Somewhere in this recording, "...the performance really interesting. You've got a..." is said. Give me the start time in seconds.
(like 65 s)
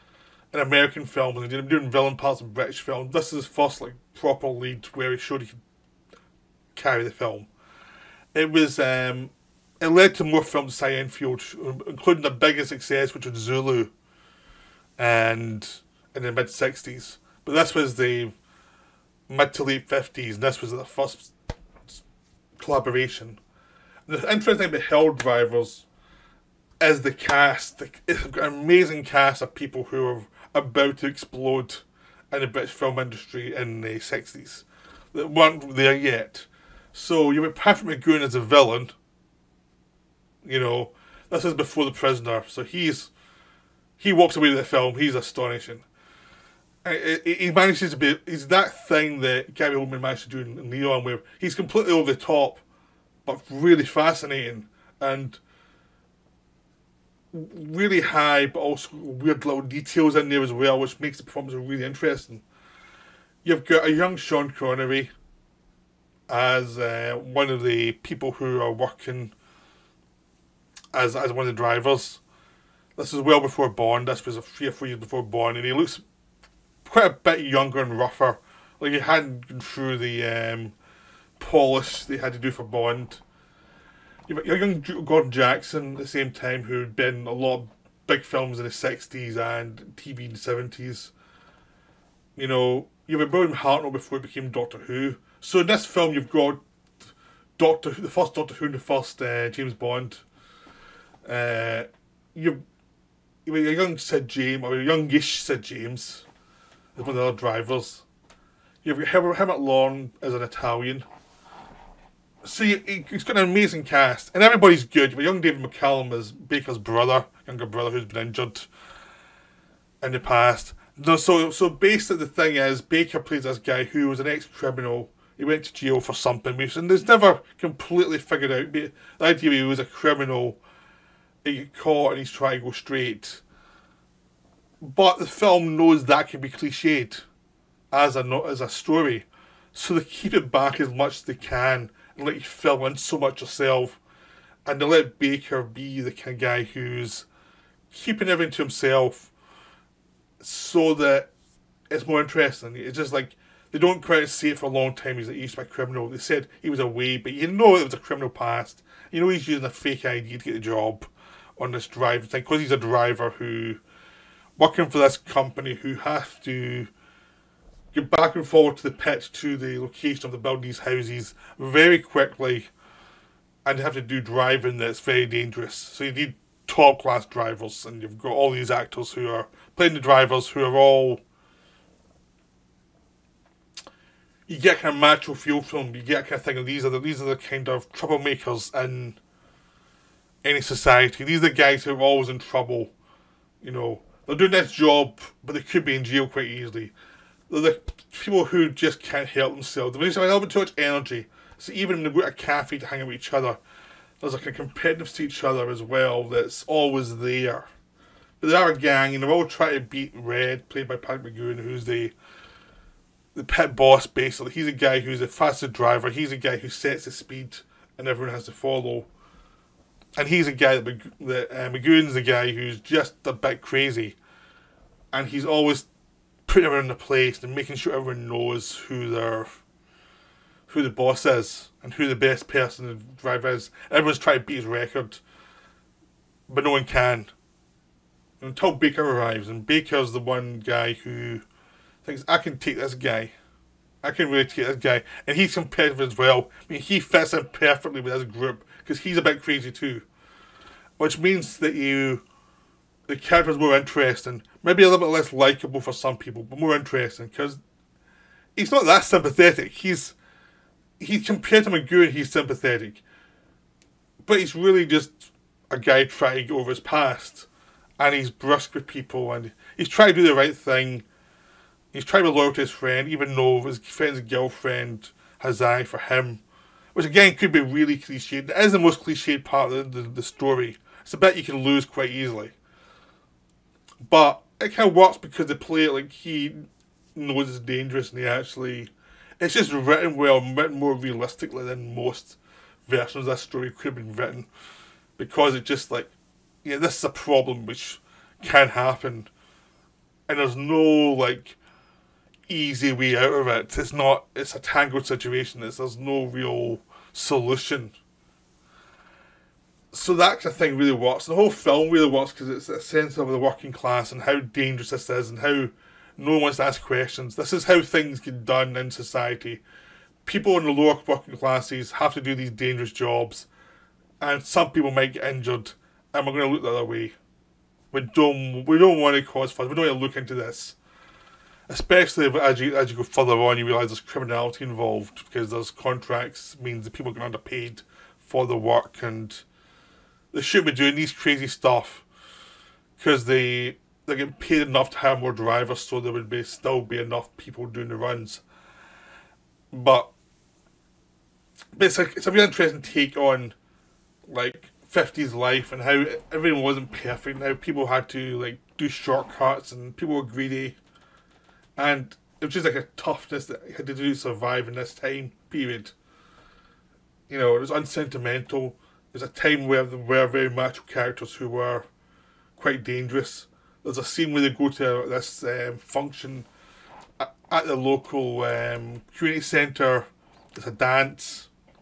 61 s.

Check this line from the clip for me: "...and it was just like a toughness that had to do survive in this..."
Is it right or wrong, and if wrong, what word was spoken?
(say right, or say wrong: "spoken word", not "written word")
right.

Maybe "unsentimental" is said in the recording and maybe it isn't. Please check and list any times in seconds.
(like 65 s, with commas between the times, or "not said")
367 s.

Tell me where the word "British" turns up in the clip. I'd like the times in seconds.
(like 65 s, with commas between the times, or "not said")
2 s, 32 s.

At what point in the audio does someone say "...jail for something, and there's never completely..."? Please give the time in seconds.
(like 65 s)
125 s.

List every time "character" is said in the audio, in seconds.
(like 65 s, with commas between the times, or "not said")
253 s, 370 s.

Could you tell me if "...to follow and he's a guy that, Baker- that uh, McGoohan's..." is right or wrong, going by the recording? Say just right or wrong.
wrong.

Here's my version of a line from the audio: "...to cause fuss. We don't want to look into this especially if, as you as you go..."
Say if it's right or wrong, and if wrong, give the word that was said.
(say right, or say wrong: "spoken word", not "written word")
right.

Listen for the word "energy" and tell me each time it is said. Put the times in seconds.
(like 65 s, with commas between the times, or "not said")
200 s.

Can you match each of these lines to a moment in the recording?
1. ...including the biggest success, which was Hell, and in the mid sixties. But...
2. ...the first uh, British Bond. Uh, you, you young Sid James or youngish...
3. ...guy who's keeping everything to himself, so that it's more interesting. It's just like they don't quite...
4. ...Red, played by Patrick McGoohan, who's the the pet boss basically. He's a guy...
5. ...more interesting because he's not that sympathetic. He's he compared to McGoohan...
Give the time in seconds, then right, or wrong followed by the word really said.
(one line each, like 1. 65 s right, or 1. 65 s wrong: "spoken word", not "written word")
1. 11 s wrong: "Zulu", not "Hell"
2. 98 s wrong: "James", not "British"
3. 146 s right
4. 210 s right
5. 256 s right.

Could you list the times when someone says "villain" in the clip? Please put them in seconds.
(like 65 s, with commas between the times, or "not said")
1 s, 38 s.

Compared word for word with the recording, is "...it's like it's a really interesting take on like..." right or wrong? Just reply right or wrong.
right.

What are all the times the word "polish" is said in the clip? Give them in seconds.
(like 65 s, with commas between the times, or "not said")
81 s.